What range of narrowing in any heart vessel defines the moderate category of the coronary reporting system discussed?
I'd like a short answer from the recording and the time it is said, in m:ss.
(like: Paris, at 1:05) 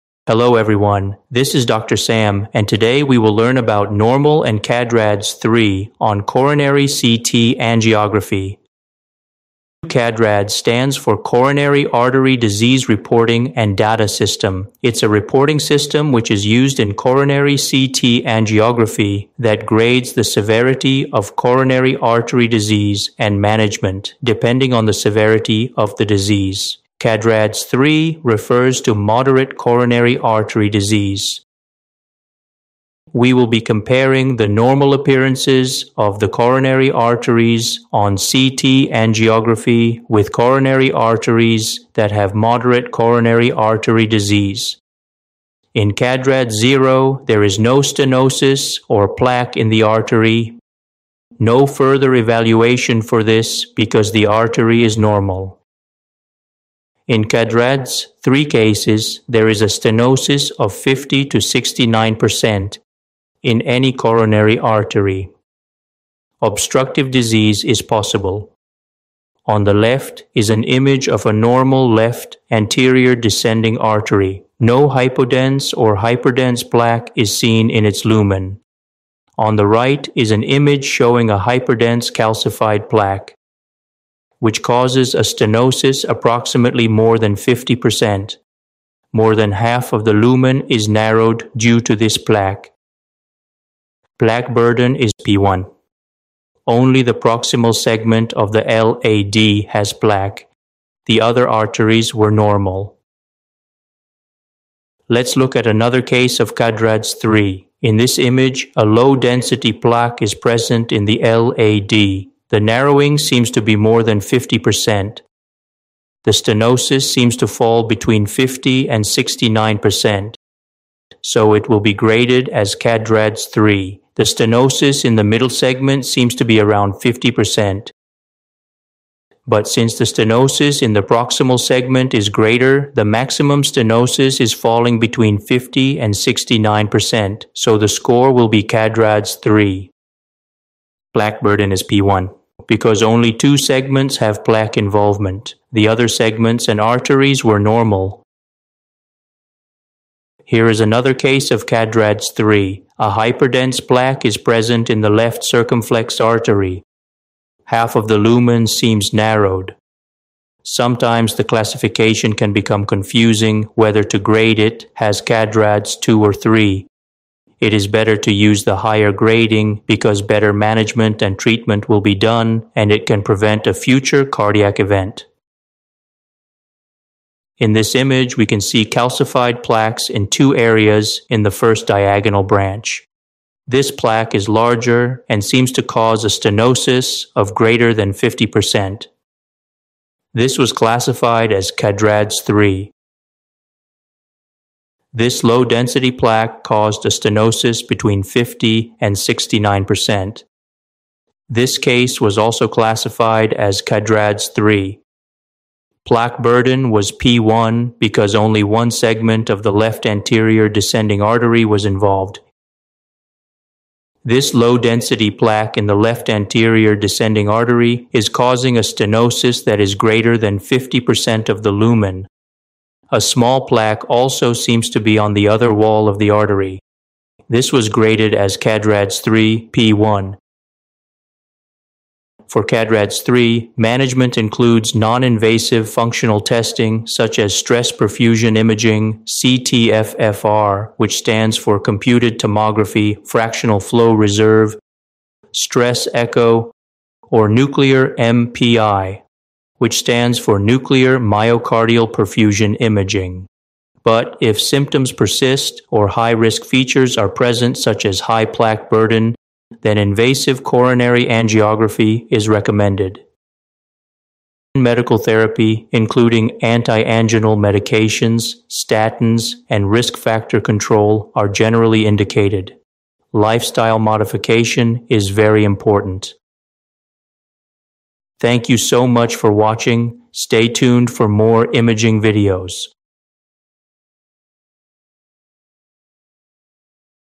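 50 to 69%, at 1:00.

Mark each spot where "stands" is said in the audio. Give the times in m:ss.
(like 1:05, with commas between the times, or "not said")
0:10, 4:01, 4:09.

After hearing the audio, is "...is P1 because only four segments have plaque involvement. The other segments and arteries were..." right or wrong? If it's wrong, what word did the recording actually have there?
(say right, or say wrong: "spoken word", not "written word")
wrong: "two", not "four".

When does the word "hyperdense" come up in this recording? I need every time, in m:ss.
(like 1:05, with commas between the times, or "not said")
1:15, 1:21, 2:33.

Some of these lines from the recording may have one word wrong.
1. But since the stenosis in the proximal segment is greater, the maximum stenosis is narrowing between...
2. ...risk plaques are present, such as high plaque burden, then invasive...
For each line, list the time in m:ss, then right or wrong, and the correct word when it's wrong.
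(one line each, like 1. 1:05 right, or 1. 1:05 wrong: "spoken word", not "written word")
1. 2:09 wrong: "falling", not "narrowing"
2. 4:16 wrong: "features", not "plaques".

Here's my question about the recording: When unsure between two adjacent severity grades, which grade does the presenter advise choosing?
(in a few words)
the higher grading.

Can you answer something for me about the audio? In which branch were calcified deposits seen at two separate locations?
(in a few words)
first diagonal branch.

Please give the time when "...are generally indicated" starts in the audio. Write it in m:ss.
4:31.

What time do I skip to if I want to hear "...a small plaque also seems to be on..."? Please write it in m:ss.
3:43.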